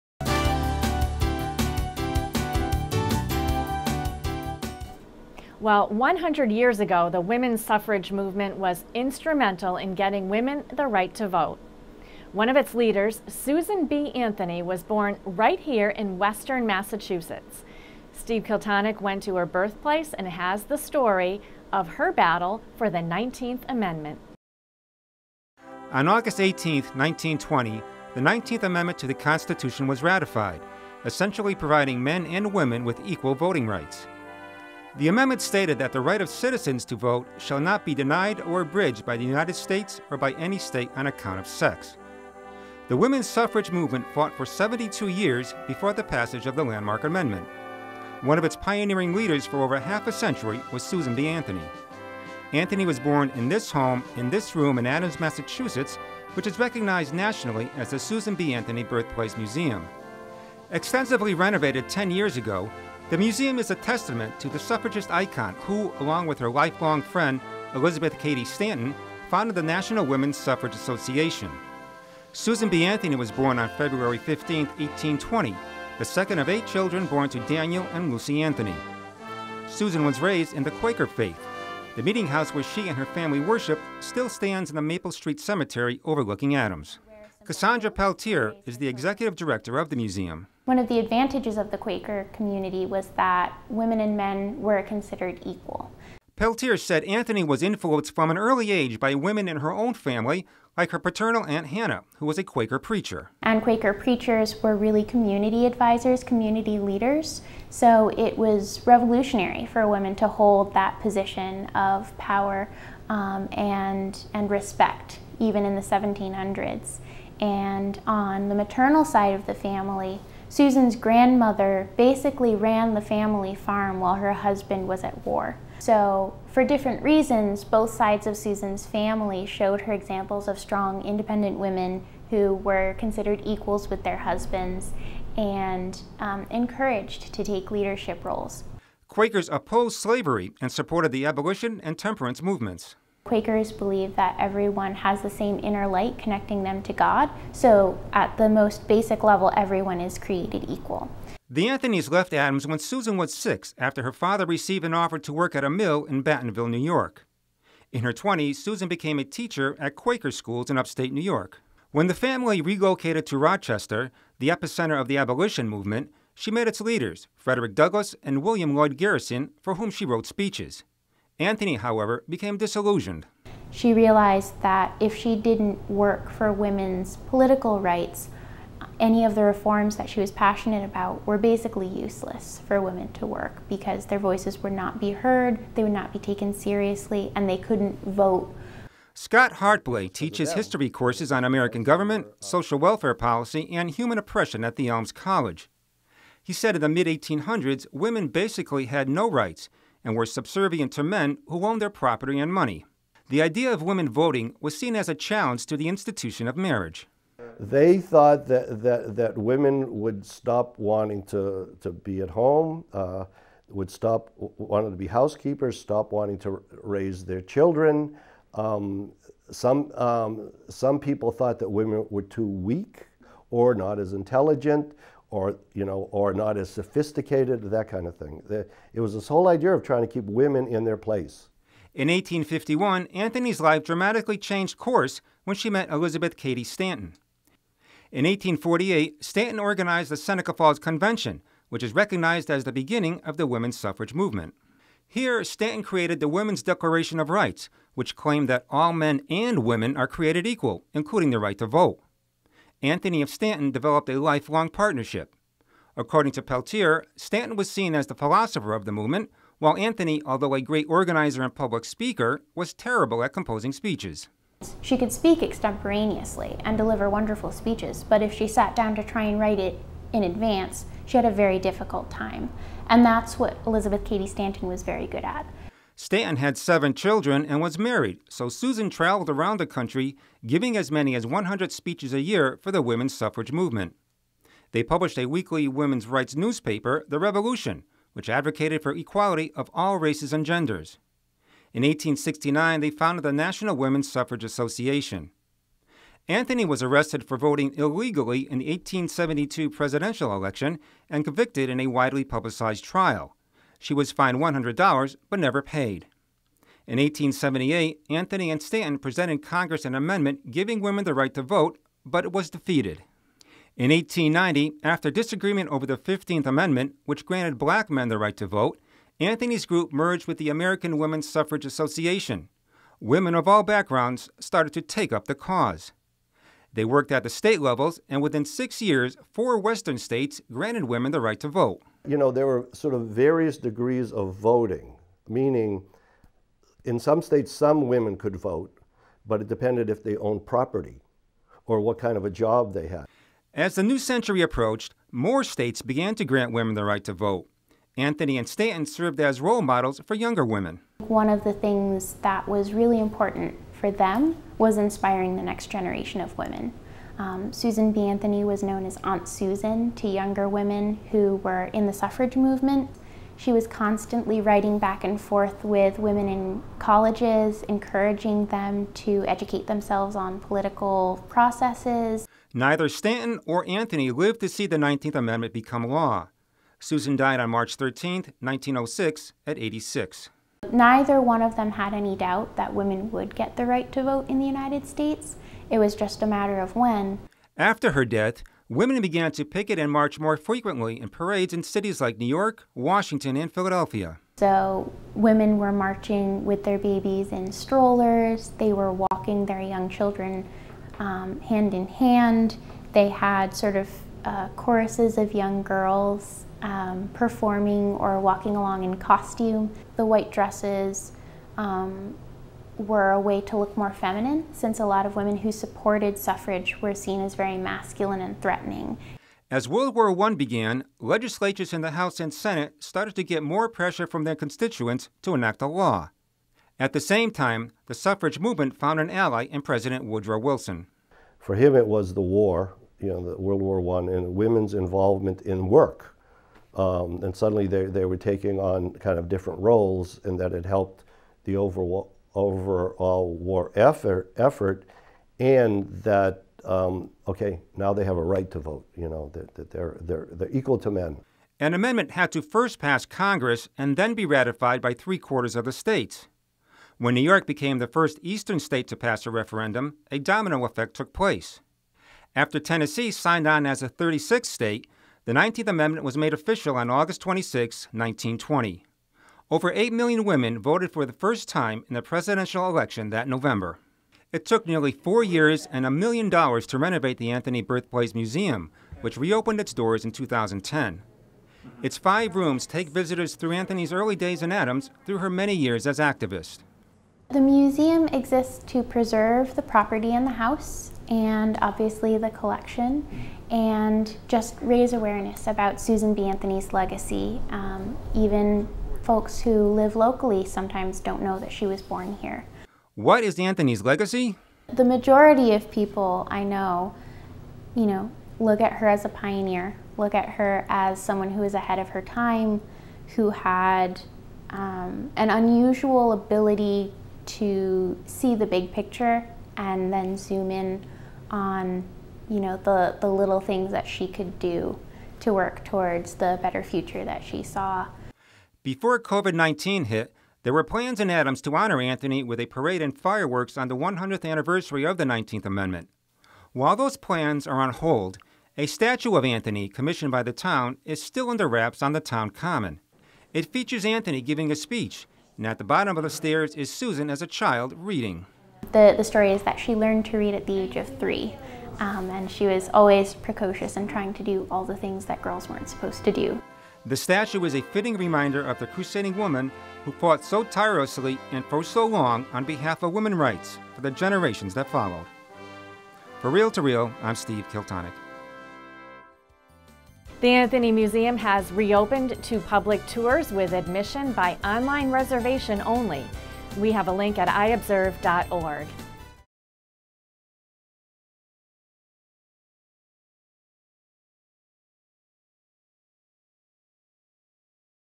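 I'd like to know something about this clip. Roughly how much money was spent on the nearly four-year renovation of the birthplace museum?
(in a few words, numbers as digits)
a million dollars.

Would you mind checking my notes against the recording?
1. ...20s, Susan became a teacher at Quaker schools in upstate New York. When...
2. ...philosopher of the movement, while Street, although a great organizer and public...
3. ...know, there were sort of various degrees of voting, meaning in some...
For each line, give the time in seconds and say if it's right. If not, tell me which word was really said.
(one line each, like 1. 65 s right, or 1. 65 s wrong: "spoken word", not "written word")
1. 158 s right
2. 258 s wrong: "Anthony", not "Street"
3. 332 s right.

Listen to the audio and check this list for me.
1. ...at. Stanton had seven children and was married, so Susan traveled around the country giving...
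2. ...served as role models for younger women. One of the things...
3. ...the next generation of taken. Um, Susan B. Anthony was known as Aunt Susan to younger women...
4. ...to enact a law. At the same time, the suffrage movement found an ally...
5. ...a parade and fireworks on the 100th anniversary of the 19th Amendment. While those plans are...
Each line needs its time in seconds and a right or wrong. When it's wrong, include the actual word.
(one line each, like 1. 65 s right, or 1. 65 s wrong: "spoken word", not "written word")
1. 275 s right
2. 348 s right
3. 355 s wrong: "women", not "taken"
4. 425 s right
5. 532 s right.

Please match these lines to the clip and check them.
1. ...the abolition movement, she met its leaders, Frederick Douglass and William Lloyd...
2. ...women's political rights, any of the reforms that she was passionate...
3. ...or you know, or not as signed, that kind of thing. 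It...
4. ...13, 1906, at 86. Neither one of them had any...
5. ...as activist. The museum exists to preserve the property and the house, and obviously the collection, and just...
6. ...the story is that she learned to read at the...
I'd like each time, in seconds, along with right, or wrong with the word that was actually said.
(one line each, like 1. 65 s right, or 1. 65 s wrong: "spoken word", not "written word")
1. 165 s right
2. 176 s right
3. 225 s wrong: "sophisticated", not "signed"
4. 377 s right
5. 485 s right
6. 548 s right.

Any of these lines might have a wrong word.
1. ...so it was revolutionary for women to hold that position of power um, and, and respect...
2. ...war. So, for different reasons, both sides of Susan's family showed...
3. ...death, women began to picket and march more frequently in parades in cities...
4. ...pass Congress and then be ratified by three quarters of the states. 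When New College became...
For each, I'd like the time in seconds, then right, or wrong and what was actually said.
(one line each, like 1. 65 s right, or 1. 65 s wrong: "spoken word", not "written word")
1. 107 s right
2. 125 s right
3. 388 s right
4. 452 s wrong: "York", not "College".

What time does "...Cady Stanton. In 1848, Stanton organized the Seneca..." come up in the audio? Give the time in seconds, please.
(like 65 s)
236 s.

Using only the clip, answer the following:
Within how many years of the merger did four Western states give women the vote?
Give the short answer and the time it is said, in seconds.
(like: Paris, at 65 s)
6, at 328 s.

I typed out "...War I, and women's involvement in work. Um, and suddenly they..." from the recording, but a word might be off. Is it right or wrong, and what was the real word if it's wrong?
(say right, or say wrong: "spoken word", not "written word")
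right.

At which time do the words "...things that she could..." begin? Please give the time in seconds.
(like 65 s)
523 s.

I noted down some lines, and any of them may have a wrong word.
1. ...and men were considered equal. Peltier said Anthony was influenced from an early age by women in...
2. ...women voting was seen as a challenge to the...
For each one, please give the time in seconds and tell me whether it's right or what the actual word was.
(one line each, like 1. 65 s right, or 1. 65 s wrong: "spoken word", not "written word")
1. 93 s right
2. 203 s right.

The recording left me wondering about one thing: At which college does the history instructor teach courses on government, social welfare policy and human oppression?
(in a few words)
Elms College.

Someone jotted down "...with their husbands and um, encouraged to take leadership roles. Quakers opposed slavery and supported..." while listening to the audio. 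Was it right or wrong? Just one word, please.
right.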